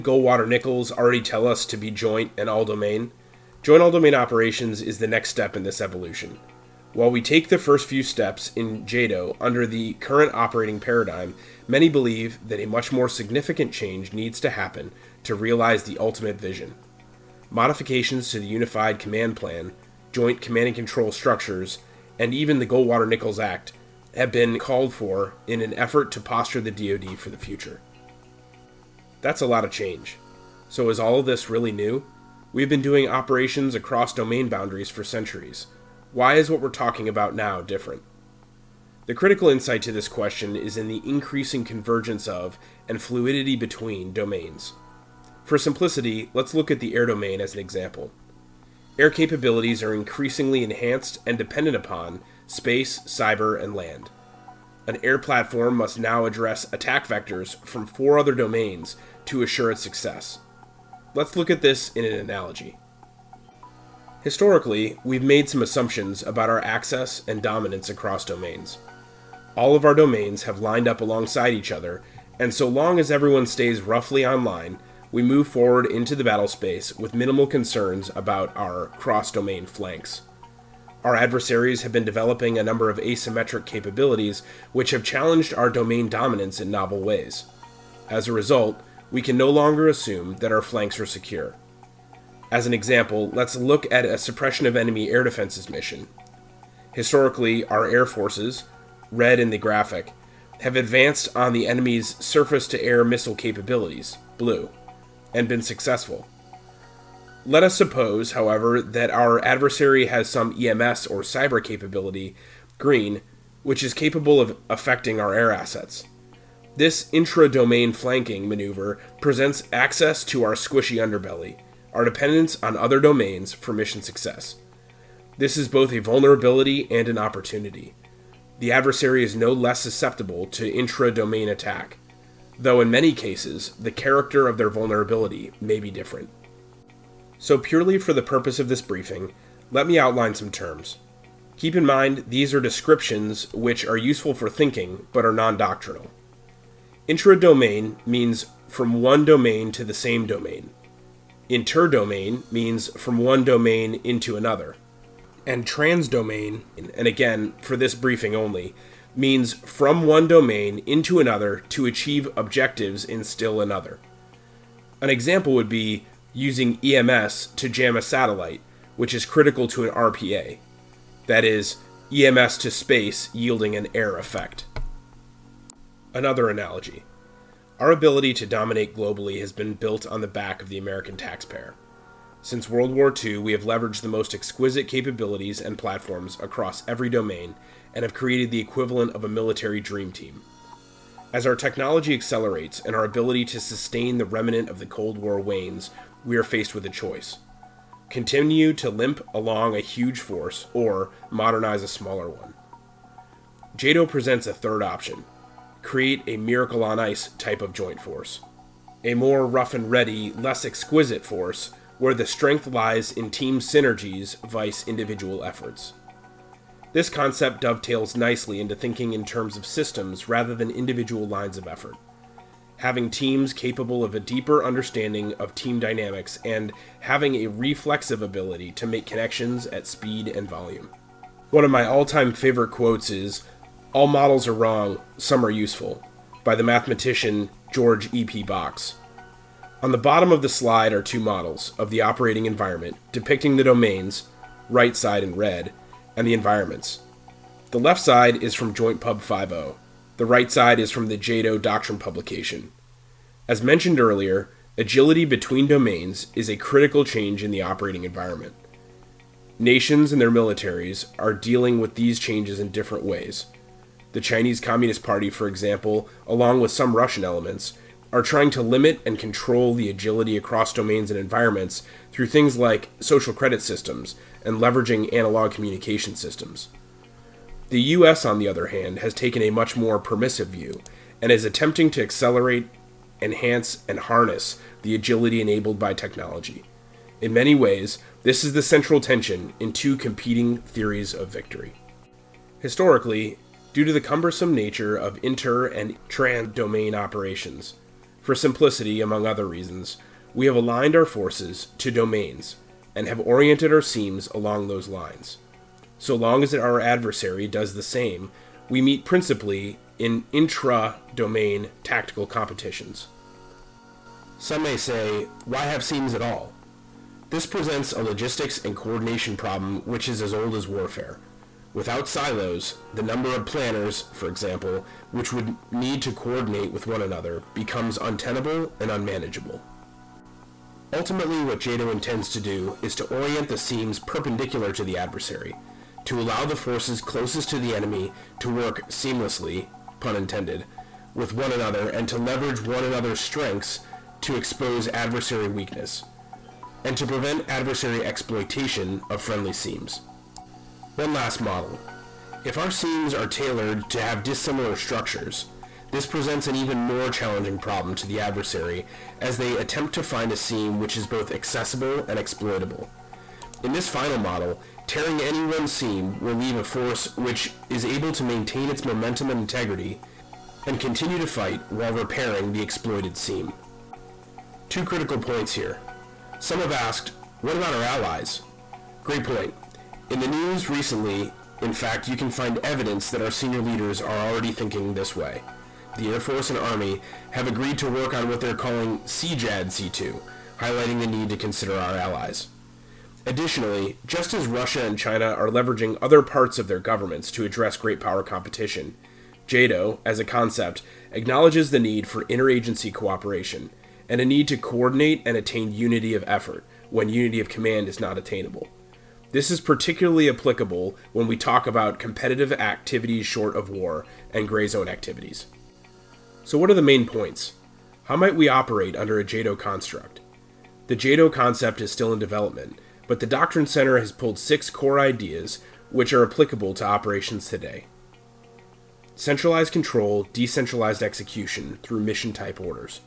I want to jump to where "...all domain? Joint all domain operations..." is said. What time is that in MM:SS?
00:02.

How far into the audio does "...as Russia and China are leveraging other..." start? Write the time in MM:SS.
06:34.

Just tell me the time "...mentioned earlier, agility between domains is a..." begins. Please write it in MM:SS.
04:13.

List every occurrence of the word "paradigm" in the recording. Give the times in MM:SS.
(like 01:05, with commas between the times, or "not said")
00:10.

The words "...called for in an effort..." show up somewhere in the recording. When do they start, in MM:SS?
00:24.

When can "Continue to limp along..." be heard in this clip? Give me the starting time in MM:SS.
03:18.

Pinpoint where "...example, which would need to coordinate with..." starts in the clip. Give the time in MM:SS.
05:24.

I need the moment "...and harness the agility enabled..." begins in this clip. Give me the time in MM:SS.
04:43.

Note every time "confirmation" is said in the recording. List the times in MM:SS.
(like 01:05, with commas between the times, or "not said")
not said.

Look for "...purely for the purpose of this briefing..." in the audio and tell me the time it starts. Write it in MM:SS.
02:17.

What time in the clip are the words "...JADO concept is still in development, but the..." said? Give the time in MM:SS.
07:00.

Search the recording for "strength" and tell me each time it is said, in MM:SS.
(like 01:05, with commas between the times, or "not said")
03:32, 05:43.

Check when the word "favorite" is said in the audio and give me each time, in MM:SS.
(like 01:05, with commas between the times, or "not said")
03:52.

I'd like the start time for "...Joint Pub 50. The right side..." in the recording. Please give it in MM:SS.
04:08.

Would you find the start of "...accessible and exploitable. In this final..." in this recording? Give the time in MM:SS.
06:01.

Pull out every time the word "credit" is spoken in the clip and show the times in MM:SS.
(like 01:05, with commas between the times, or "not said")
04:33.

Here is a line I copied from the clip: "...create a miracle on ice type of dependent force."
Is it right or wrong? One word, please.
wrong.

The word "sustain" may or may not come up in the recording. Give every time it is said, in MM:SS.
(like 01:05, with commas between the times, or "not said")
03:13.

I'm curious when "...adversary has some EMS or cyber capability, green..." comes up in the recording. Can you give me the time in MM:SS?
01:49.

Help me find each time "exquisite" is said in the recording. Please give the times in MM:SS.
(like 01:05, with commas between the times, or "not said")
03:04, 03:30.